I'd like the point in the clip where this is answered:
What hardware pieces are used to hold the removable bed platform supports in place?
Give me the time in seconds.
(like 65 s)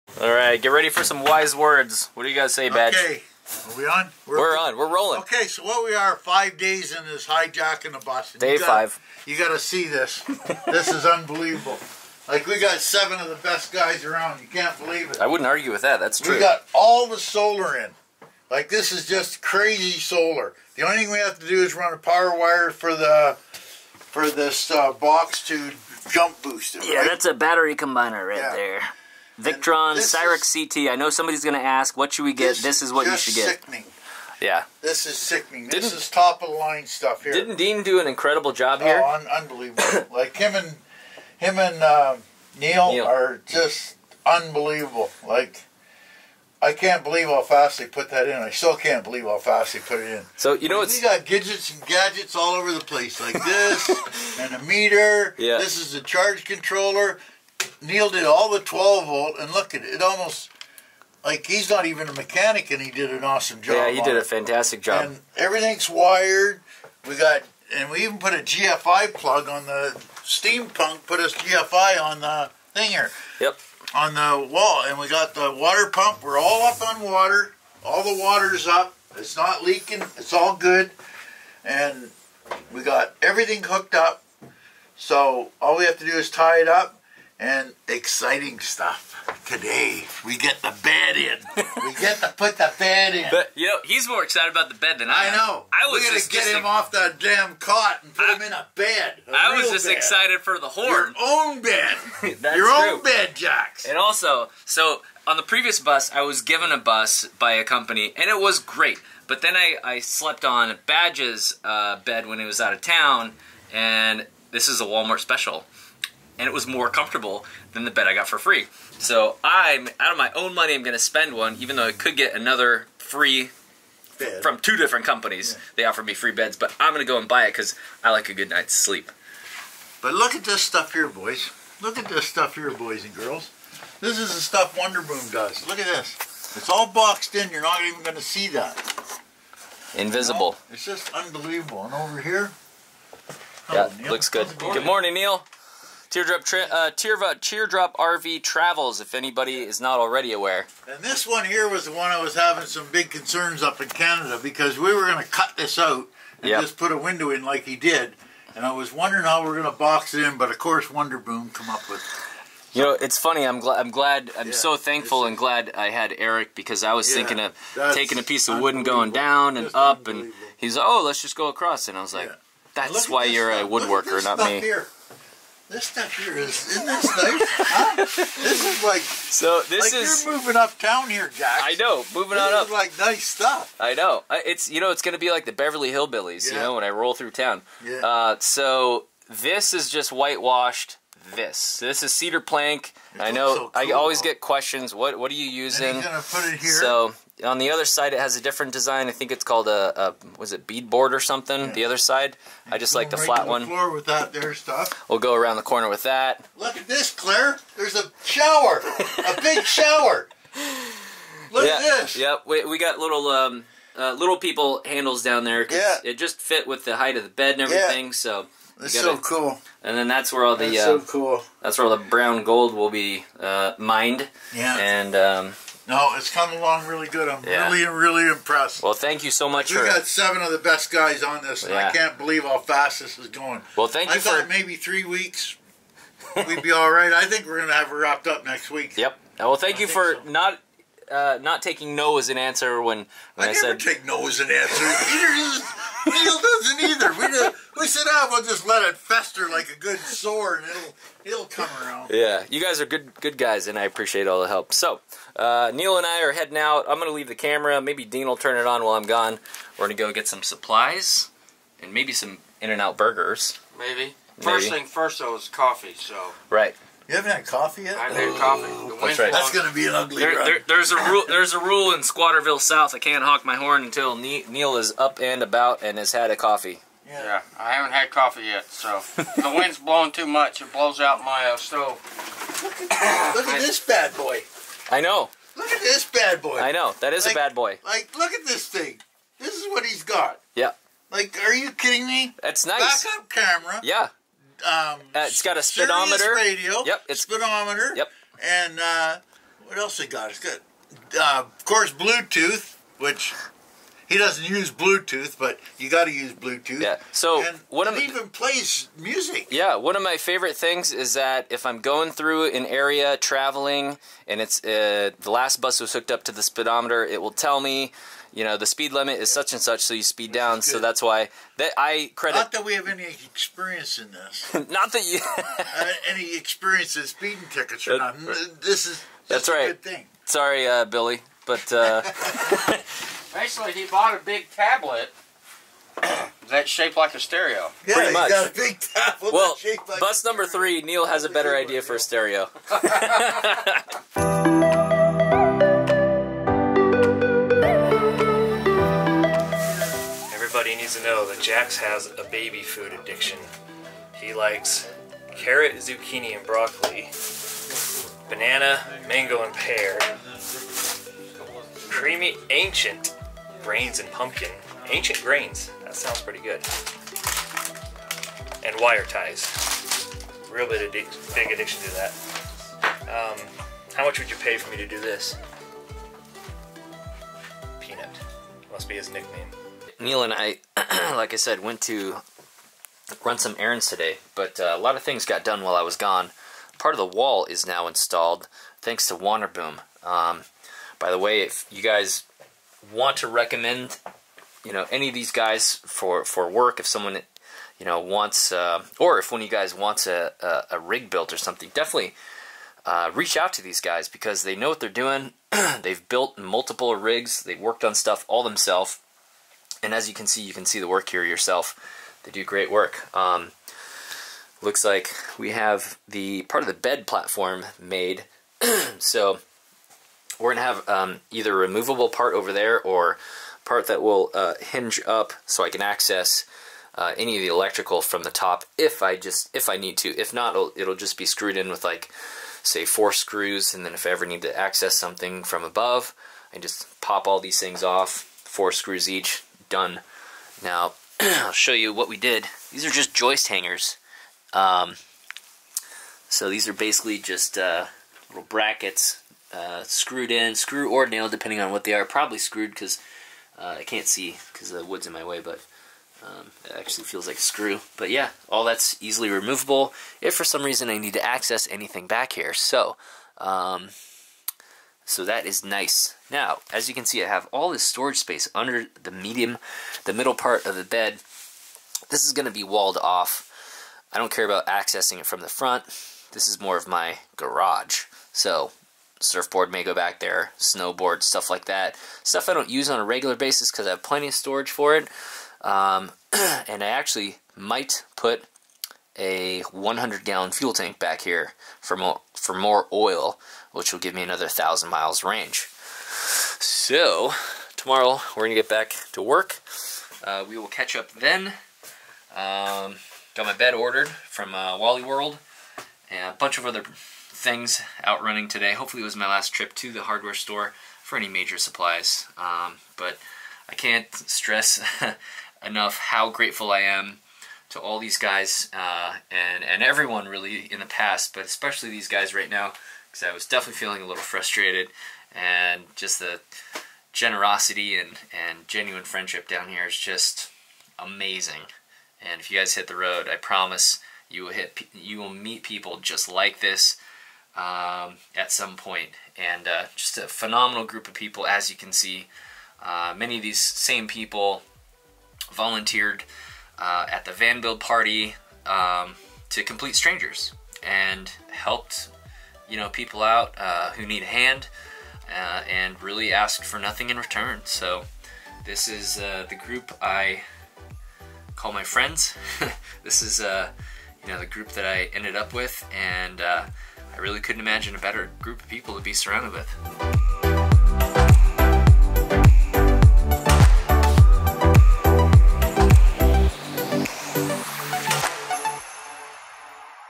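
443 s.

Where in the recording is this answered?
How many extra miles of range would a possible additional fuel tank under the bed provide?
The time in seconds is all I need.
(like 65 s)
494 s.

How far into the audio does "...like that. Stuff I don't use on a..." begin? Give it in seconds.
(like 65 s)
481 s.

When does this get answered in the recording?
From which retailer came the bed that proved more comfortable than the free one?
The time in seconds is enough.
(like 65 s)
114 s.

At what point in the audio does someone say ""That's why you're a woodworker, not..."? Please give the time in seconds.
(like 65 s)
172 s.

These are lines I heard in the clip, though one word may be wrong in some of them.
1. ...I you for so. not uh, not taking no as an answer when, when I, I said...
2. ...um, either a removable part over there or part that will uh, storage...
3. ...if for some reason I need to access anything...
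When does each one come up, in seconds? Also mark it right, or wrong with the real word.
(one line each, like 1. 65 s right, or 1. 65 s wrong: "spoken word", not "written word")
1. 239 s right
2. 420 s wrong: "hinge", not "storage"
3. 460 s right.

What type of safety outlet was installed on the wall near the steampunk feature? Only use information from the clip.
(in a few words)
GFI plug.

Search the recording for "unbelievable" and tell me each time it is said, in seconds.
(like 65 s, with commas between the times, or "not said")
11 s, 39 s, 44 s, 141 s.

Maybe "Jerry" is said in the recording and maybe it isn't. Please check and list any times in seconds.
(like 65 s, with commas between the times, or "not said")
not said.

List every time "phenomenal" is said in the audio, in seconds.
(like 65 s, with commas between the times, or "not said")
540 s.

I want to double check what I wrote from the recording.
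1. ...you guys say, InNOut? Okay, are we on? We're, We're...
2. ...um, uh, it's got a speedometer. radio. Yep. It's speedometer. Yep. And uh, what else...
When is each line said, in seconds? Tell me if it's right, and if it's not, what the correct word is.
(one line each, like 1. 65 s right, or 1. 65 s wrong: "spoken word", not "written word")
1. 2 s wrong: "Badge", not "InNOut"
2. 294 s right.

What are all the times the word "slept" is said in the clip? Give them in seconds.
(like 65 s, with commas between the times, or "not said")
109 s.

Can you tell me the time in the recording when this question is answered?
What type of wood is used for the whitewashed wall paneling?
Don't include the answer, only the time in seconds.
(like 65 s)
192 s.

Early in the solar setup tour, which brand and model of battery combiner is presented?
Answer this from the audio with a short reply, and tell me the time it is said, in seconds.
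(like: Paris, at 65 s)
Victron Cyrix, at 29 s.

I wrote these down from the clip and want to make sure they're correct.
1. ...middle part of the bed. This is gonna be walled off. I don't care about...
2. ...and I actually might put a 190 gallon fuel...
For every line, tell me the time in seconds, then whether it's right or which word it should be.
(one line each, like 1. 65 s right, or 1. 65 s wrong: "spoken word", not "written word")
1. 470 s right
2. 486 s wrong: "100", not "190".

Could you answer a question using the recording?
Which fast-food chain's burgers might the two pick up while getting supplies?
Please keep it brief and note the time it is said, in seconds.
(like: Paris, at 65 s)
In-N-Out, at 262 s.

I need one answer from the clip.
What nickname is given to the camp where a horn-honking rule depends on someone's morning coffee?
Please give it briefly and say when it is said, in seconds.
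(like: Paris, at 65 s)
Squatterville South, at 272 s.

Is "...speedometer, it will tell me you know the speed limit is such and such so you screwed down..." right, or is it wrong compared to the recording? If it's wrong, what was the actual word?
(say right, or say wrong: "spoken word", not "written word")
wrong: "speed", not "screwed".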